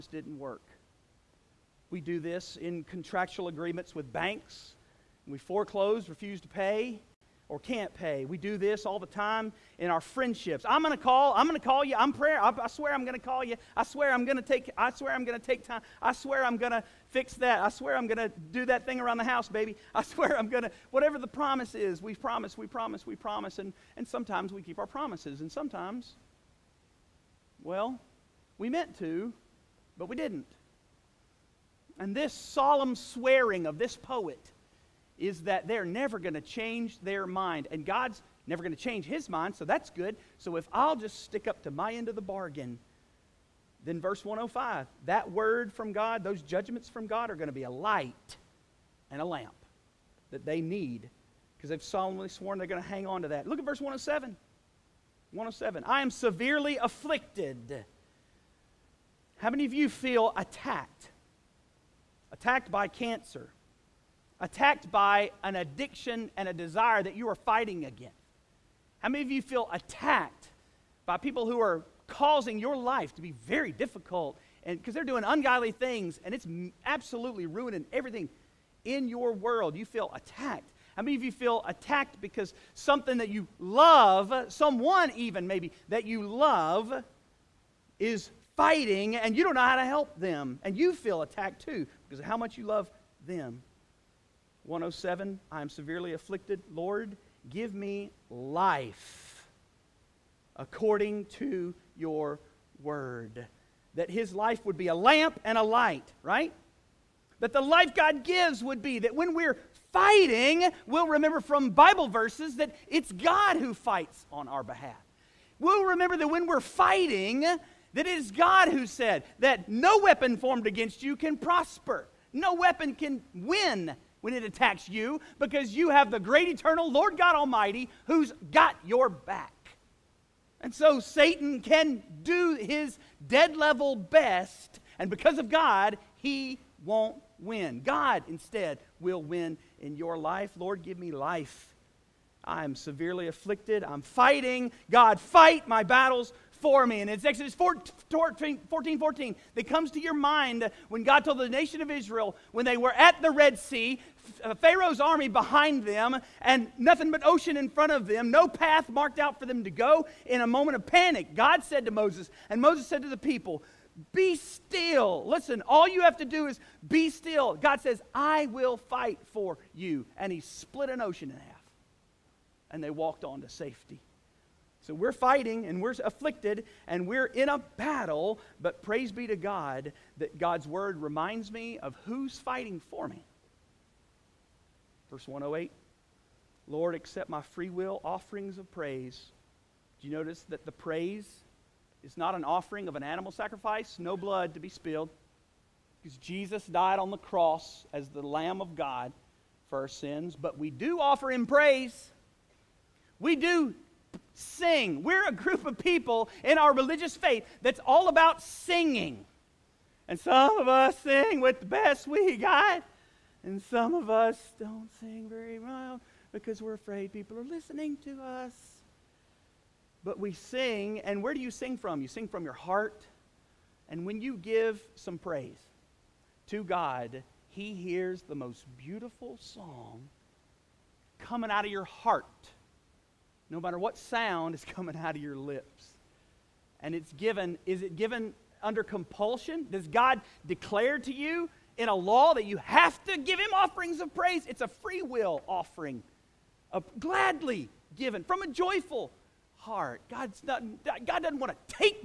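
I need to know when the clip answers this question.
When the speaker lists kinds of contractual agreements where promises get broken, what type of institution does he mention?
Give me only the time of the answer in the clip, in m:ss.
0:04.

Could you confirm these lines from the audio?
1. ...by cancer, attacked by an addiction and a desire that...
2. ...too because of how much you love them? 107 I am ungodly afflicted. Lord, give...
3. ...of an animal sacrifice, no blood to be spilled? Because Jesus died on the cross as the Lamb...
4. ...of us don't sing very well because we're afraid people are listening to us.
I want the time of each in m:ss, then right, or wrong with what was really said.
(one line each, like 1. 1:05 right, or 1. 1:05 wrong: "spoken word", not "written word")
1. 1:02 right
2. 1:31 wrong: "severely", not "ungodly"
3. 3:12 right
4. 3:33 right.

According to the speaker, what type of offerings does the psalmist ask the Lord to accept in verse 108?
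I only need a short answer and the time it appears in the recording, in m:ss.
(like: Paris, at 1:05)
Free will offerings of praise, at 3:07.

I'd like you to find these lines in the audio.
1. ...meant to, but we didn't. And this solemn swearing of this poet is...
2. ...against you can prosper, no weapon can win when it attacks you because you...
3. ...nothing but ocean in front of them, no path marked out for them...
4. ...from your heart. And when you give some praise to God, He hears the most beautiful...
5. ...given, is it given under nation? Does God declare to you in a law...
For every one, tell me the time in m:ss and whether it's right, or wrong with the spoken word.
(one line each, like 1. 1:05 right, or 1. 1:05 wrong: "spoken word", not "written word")
1. 0:28 right
2. 2:00 right
3. 2:36 right
4. 3:42 right
5. 3:57 wrong: "compulsion", not "nation".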